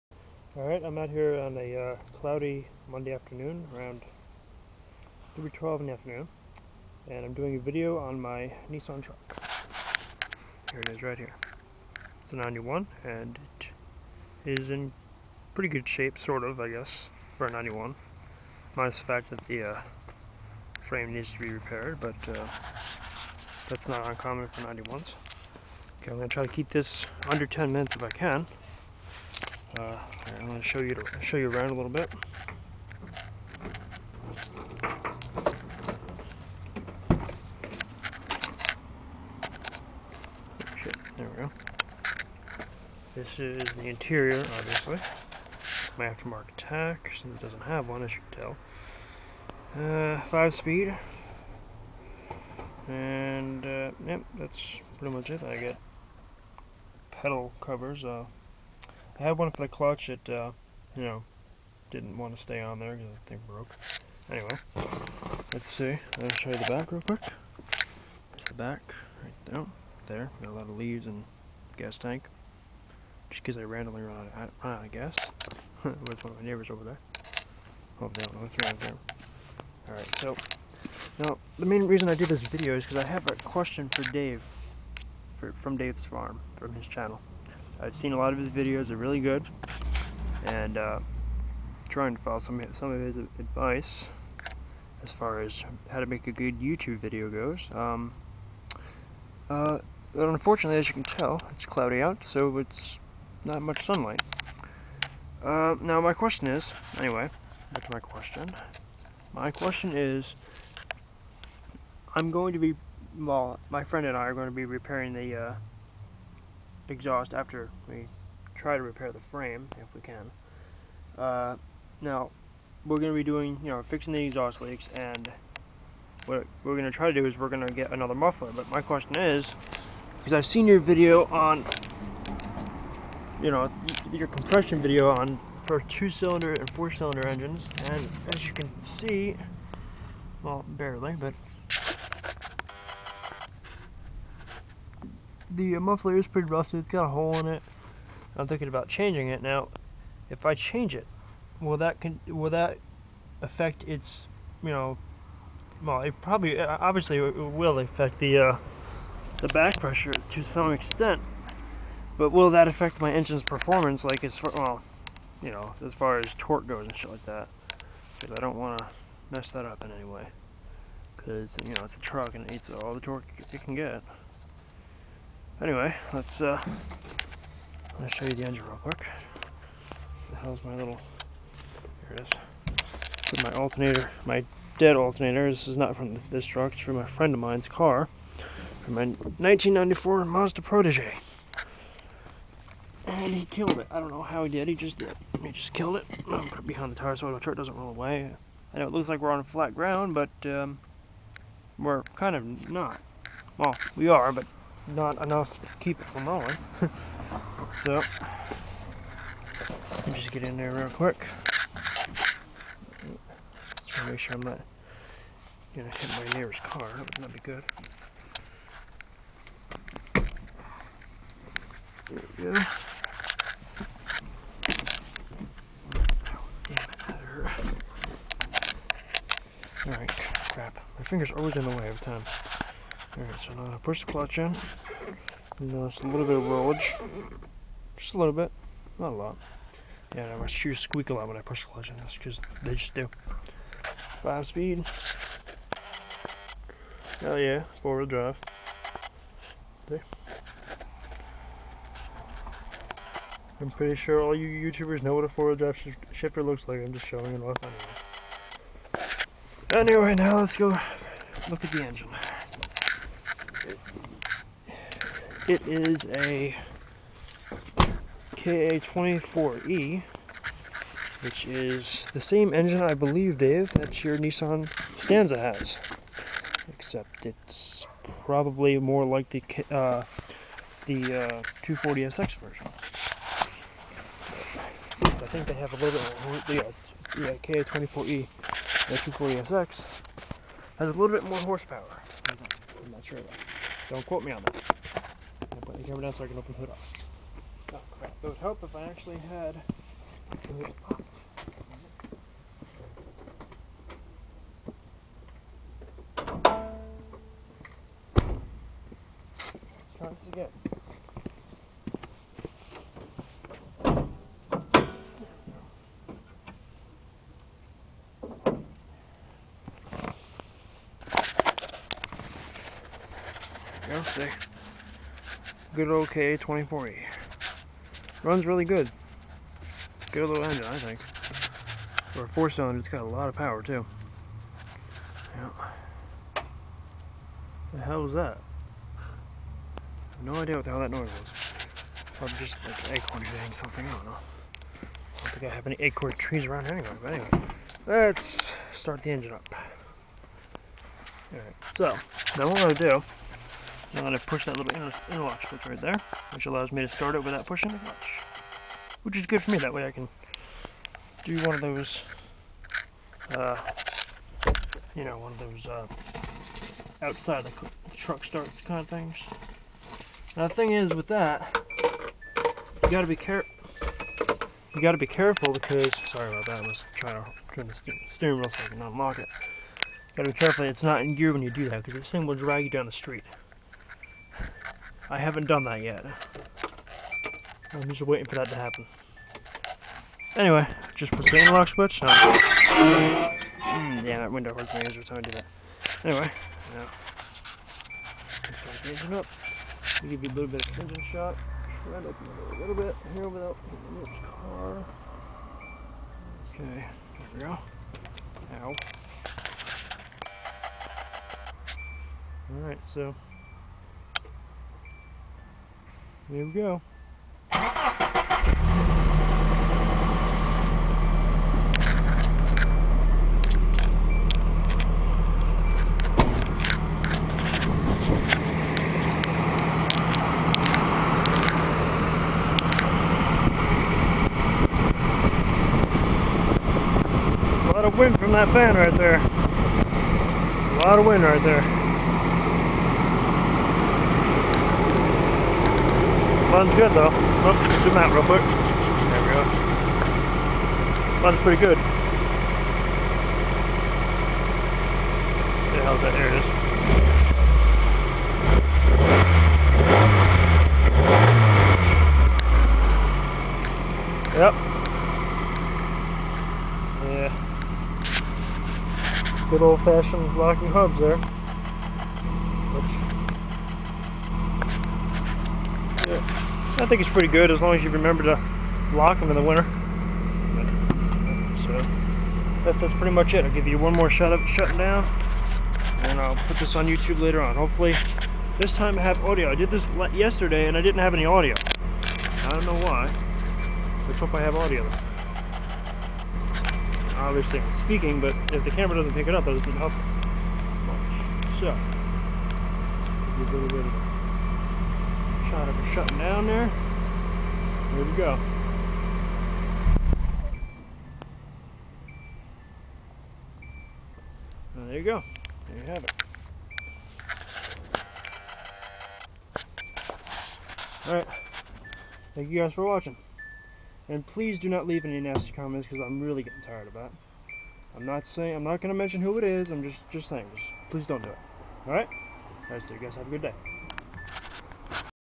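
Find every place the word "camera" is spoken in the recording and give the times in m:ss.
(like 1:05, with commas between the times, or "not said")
4:55, 8:18.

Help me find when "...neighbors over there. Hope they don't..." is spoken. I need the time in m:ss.
1:16.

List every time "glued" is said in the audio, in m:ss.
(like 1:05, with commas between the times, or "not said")
not said.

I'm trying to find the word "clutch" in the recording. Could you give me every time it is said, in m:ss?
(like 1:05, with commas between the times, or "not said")
0:59, 3:54, 4:01.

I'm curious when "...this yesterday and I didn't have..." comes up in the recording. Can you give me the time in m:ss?
8:09.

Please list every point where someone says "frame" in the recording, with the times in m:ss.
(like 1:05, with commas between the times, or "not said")
0:20, 1:59.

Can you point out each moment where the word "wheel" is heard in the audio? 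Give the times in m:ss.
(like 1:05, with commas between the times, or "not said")
4:07, 4:15, 6:18.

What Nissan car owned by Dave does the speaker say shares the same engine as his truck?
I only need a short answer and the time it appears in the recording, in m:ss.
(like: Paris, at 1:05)
Stanza, at 4:34.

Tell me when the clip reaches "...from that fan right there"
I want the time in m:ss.
7:18.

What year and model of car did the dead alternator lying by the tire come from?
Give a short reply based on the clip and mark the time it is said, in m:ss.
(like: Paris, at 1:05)
1994 Mazda Protege, at 3:09.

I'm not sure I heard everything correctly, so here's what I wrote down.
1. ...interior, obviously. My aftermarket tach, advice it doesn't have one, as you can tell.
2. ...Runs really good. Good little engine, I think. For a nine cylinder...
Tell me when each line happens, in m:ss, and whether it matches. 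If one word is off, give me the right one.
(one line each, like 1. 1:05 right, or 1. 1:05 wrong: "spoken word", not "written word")
1. 0:43 wrong: "since", not "advice"
2. 5:28 wrong: "four", not "nine".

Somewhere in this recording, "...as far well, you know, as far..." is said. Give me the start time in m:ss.
2:44.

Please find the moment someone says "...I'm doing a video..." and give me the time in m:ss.
0:07.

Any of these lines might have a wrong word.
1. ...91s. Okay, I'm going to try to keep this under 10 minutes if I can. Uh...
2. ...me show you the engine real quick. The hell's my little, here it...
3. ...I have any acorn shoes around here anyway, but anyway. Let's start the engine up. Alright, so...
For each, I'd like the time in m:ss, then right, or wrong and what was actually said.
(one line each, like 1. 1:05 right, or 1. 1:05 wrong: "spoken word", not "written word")
1. 0:24 right
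2. 2:58 right
3. 5:45 wrong: "trees", not "shoes".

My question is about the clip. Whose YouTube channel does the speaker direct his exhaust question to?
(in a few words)
Dave's farm.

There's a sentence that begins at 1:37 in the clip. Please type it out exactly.
Um, uh, but unfortunately, as you can tell, it's cloudy out, so it's not much sunlight.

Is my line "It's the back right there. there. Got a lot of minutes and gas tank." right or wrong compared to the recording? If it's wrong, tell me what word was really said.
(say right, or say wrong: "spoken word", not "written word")
wrong: "leaves", not "minutes".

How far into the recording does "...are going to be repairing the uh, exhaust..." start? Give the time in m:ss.
1:54.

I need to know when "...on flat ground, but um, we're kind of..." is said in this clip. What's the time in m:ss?
3:19.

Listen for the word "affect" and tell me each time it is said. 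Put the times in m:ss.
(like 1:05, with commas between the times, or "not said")
2:33, 2:37, 2:42.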